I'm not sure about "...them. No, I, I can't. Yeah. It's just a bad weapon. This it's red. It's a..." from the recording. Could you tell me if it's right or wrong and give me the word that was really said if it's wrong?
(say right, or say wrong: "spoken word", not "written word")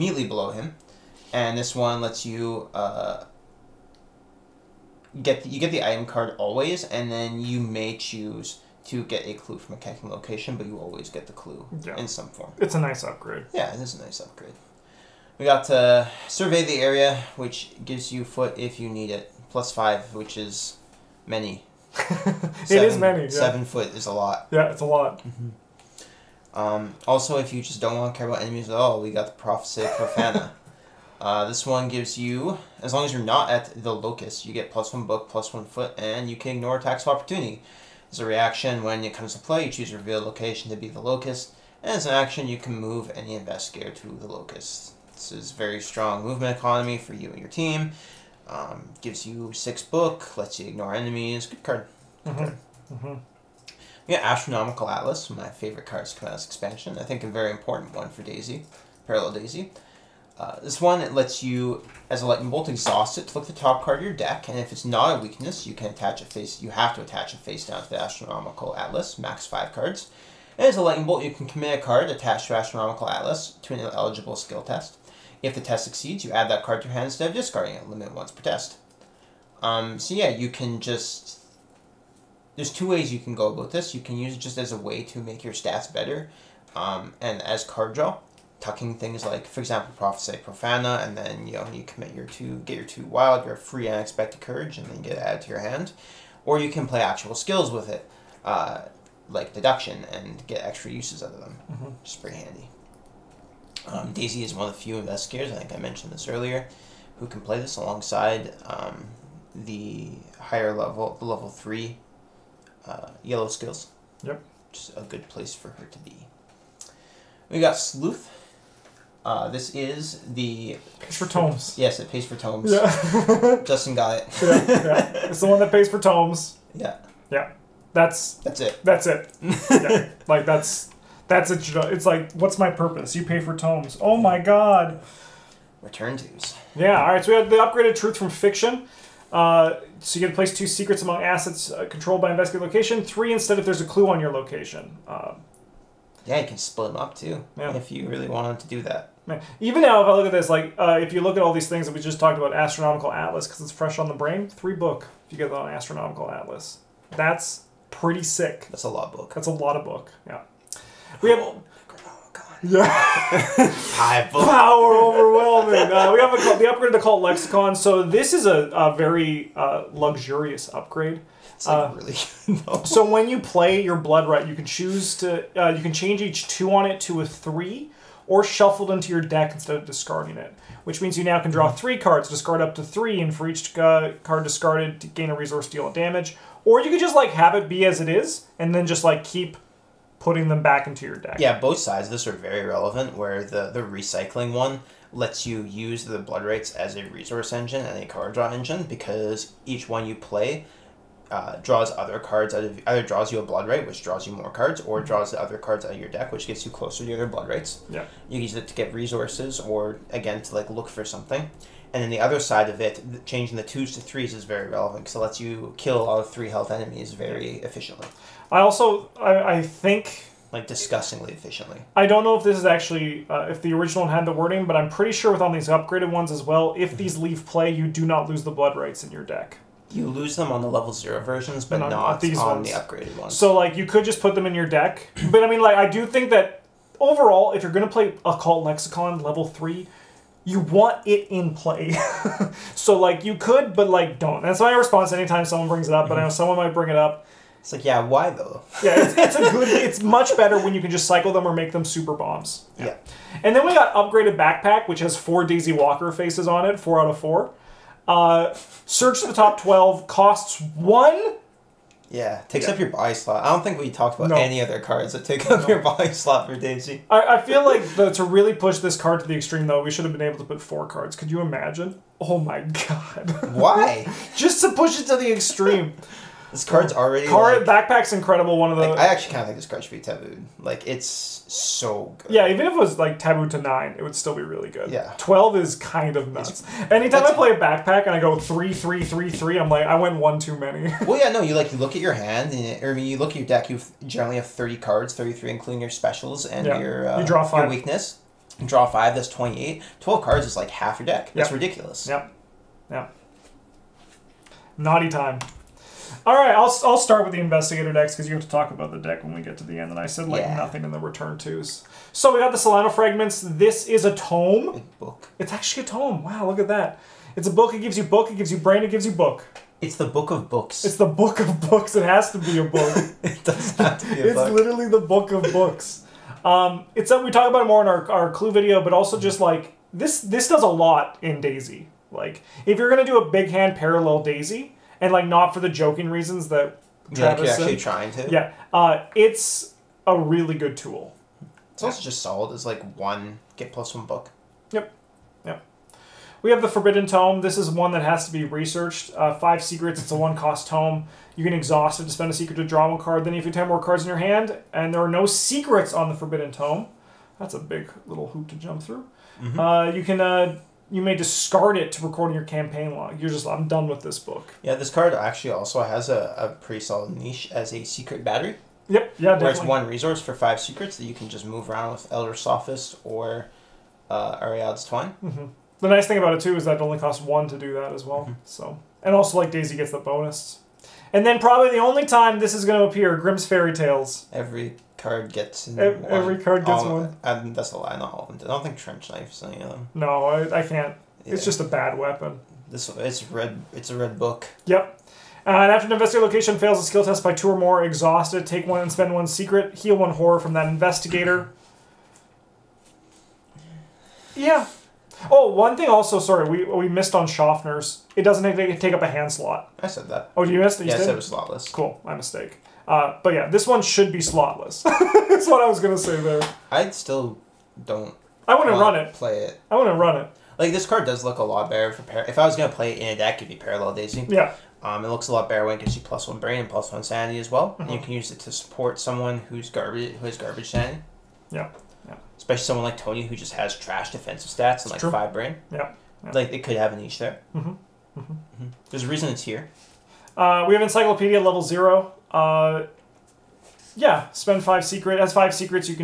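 right.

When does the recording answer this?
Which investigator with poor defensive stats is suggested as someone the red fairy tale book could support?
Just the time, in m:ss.
7:12.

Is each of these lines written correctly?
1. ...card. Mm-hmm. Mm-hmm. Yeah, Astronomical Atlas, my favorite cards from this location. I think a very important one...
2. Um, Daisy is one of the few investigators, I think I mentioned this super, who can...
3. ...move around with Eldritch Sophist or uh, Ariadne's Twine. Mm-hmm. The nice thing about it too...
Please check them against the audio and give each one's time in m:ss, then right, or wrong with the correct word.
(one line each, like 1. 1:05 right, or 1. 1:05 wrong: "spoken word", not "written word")
1. 0:51 wrong: "expansion", not "location"
2. 1:43 wrong: "earlier", not "super"
3. 6:11 right.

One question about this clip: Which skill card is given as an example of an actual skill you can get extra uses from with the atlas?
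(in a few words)
Deduction.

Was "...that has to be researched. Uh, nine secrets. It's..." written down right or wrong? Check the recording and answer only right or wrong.
wrong.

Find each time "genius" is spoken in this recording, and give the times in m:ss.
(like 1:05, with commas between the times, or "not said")
not said.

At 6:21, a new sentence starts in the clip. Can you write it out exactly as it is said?
And then probably the only time this is going to appear, Grimm's Fairy Tales.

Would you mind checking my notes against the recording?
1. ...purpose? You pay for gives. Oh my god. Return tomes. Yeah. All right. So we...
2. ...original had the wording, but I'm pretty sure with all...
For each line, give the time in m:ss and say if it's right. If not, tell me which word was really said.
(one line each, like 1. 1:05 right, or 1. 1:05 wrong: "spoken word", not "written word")
1. 2:12 wrong: "tomes", not "gives"
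2. 3:43 right.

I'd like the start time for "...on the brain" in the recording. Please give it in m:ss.
2:33.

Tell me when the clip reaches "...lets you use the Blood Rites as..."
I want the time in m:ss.
3:15.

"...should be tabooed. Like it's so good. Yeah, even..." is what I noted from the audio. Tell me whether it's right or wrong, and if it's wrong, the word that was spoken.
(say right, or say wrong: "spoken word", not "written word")
right.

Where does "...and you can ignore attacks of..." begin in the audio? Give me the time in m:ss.
0:35.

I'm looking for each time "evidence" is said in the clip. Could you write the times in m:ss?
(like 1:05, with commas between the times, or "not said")
not said.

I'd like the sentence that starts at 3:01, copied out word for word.
three cards, discard up to three, and for each card discarded, gain a resource, deal damage.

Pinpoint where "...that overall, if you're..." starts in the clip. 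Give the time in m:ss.
3:56.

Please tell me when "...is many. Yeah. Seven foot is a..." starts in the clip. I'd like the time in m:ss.
0:22.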